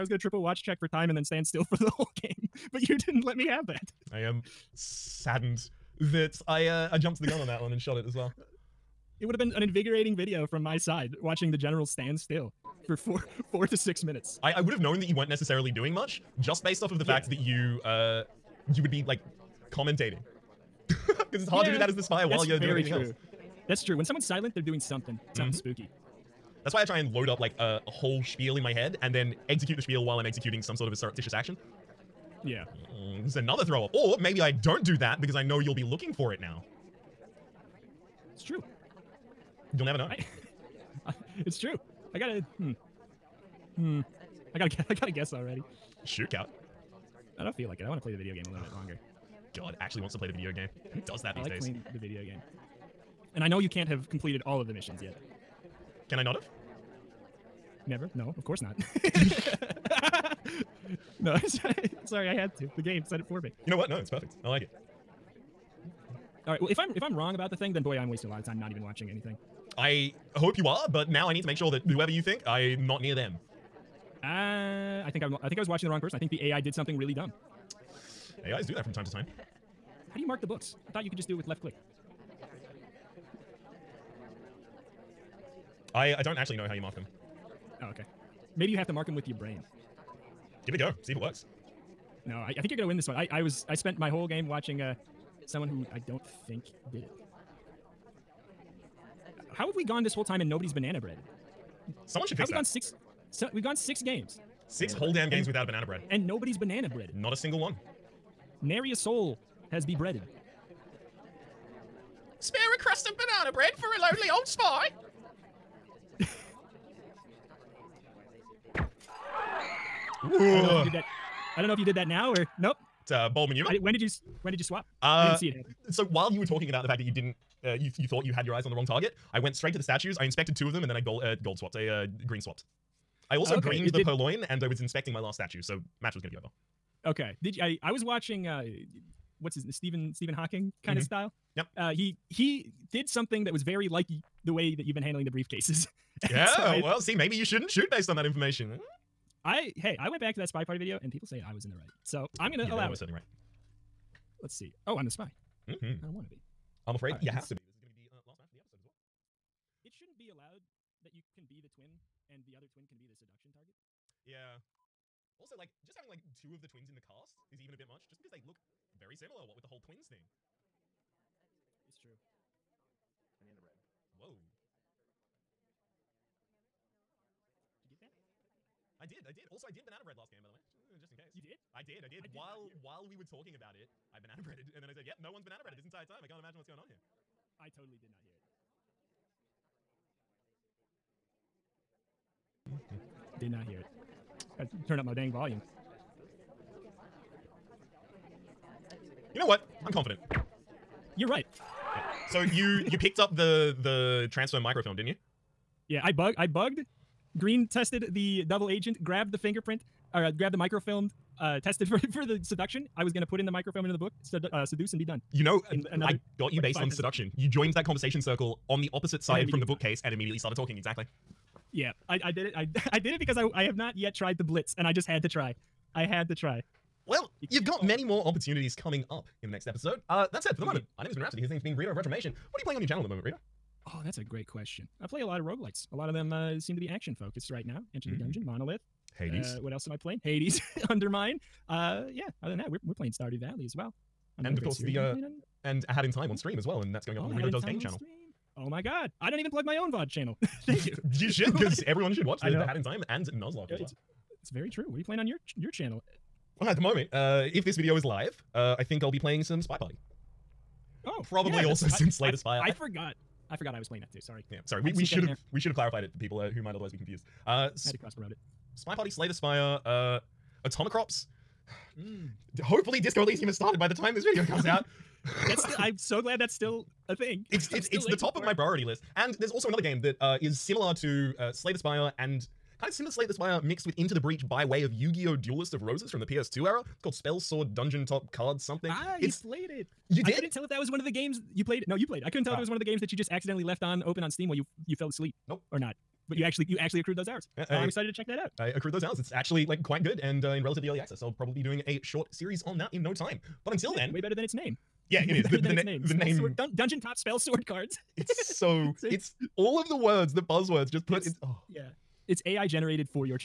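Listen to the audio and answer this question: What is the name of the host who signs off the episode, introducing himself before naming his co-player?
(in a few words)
Rhapsody.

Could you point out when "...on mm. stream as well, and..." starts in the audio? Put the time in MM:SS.
04:06.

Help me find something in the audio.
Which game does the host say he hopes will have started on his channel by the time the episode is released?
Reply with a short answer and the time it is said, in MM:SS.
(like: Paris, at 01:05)
Disco Elysium, at 04:32.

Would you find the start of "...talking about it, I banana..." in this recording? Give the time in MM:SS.
03:03.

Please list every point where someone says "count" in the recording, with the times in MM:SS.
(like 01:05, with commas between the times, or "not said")
00:46.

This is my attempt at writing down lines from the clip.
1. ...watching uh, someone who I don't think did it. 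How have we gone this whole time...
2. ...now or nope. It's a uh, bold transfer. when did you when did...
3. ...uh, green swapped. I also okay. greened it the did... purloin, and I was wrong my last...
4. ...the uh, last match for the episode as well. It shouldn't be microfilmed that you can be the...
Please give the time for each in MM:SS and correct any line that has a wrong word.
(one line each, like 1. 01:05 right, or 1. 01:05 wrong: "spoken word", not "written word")
1. 01:34 right
2. 02:02 wrong: "maneuver", not "transfer"
3. 02:11 wrong: "inspecting", not "wrong"
4. 02:38 wrong: "allowed", not "microfilmed".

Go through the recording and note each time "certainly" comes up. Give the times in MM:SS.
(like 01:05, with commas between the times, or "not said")
02:32.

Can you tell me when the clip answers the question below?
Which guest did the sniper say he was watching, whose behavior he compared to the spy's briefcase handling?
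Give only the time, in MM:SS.
02:20.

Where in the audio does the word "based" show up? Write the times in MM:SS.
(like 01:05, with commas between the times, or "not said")
00:16, 02:27, 03:36.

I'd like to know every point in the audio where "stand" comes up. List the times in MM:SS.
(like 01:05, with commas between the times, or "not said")
00:01, 00:11.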